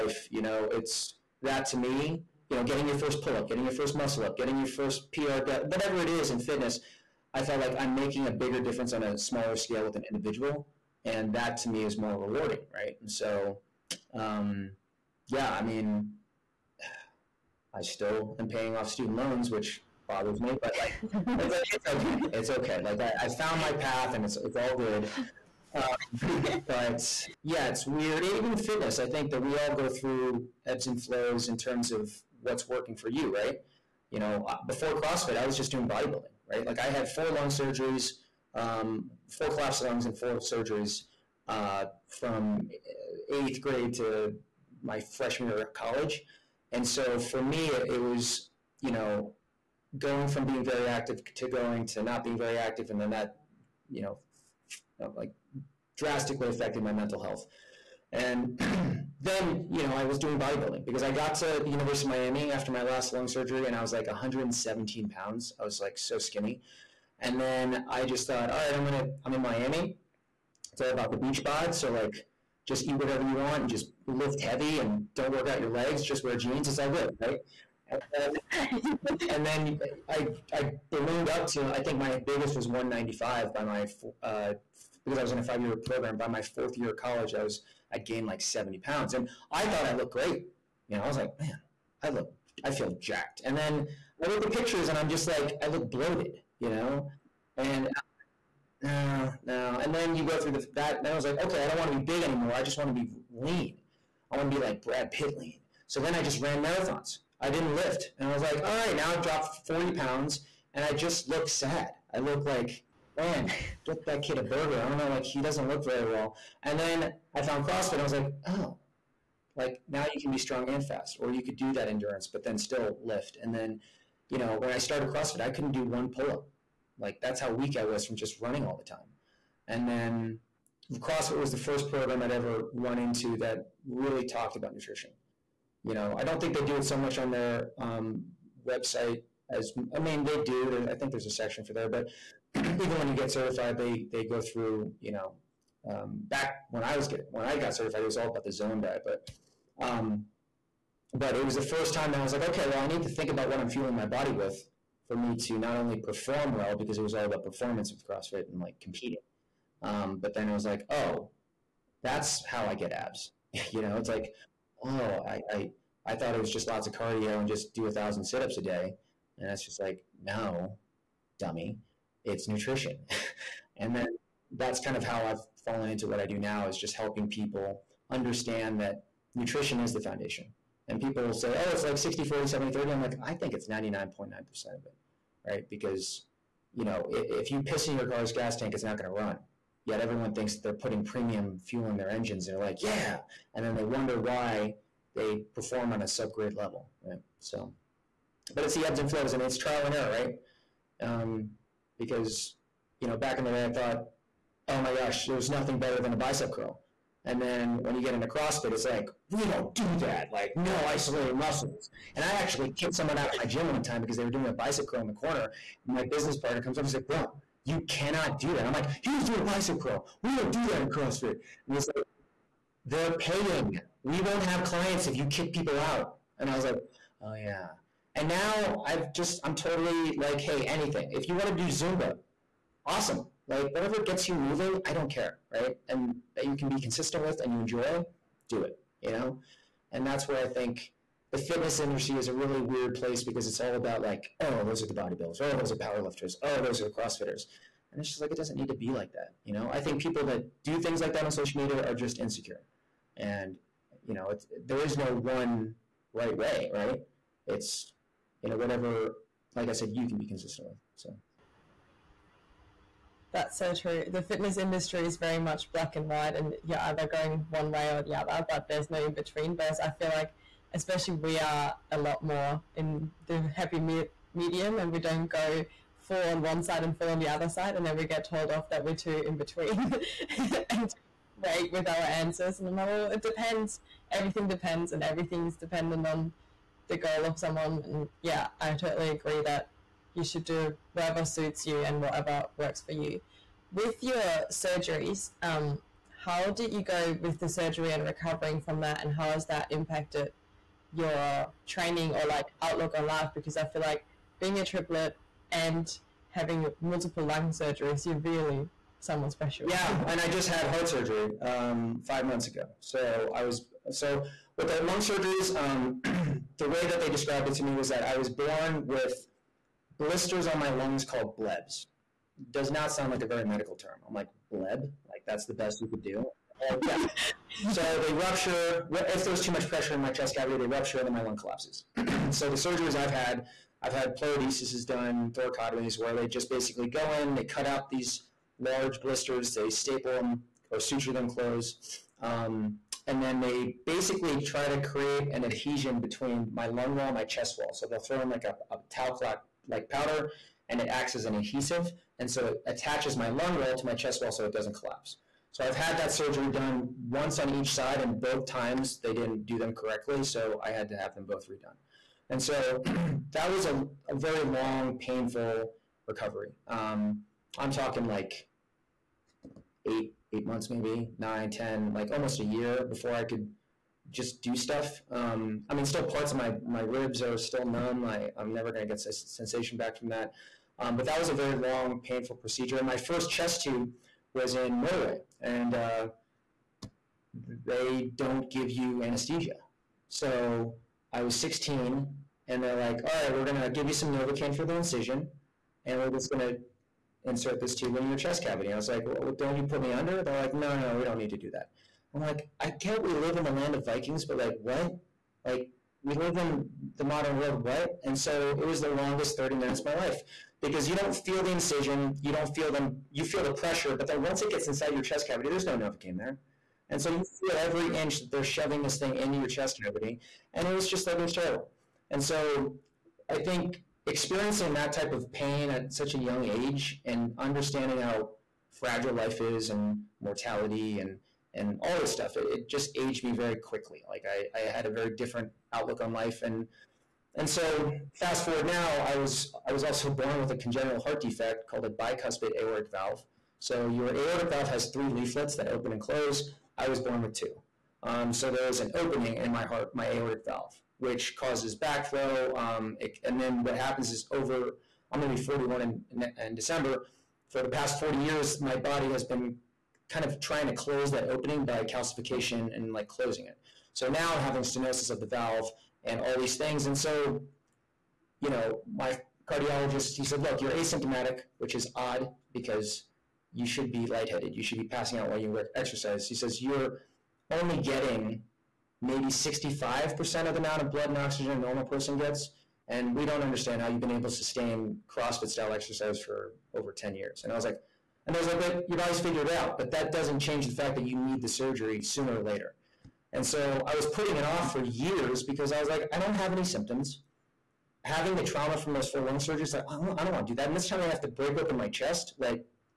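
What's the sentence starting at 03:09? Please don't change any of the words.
Yet everyone thinks they're putting premium fuel in their engines.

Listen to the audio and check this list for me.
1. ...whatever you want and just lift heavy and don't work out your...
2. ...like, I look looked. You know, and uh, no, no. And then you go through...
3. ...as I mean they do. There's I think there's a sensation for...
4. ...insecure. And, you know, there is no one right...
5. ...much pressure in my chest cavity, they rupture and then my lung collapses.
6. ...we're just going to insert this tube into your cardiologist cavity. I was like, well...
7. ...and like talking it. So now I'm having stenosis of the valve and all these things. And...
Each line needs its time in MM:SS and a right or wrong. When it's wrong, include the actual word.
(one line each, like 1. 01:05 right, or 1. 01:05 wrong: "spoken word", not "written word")
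1. 01:12 right
2. 01:35 wrong: "bloated", not "looked"
3. 02:19 wrong: "section", not "sensation"
4. 04:12 right
5. 05:29 right
6. 06:36 wrong: "chest", not "cardiologist"
7. 07:42 wrong: "closing", not "talking".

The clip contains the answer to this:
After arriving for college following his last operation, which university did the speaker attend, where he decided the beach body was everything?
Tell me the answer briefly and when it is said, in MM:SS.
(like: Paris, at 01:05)
University of Miami, at 01:01.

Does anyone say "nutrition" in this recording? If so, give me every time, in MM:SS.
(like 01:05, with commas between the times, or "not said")
02:14, 02:52, 02:59.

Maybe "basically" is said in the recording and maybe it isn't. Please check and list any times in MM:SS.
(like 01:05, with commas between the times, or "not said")
05:36, 05:43.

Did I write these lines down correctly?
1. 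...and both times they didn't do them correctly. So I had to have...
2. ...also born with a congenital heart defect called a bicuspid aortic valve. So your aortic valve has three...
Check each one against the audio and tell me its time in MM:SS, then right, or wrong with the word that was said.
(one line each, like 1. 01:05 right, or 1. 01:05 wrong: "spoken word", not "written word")
1. 05:58 right
2. 07:19 right.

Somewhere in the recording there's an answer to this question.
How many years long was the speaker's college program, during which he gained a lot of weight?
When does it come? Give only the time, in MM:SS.
01:25.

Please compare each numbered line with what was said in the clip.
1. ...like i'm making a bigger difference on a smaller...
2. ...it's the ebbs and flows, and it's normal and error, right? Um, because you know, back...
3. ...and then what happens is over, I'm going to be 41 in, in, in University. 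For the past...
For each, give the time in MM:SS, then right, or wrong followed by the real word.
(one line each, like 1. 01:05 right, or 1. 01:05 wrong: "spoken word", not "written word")
1. 00:07 right
2. 03:18 wrong: "trial", not "normal"
3. 07:33 wrong: "December", not "University".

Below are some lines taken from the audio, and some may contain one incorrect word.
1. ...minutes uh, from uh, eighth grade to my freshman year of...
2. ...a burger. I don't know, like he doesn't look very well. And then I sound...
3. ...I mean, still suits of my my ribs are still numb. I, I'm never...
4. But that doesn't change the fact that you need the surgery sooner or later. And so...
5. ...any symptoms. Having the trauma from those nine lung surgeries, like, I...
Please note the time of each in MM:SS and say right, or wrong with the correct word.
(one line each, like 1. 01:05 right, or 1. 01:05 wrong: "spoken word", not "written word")
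1. 00:40 wrong: "surgeries", not "minutes"
2. 01:54 wrong: "found", not "sound"
3. 06:15 wrong: "parts", not "suits"
4. 08:09 right
5. 08:16 wrong: "four", not "nine".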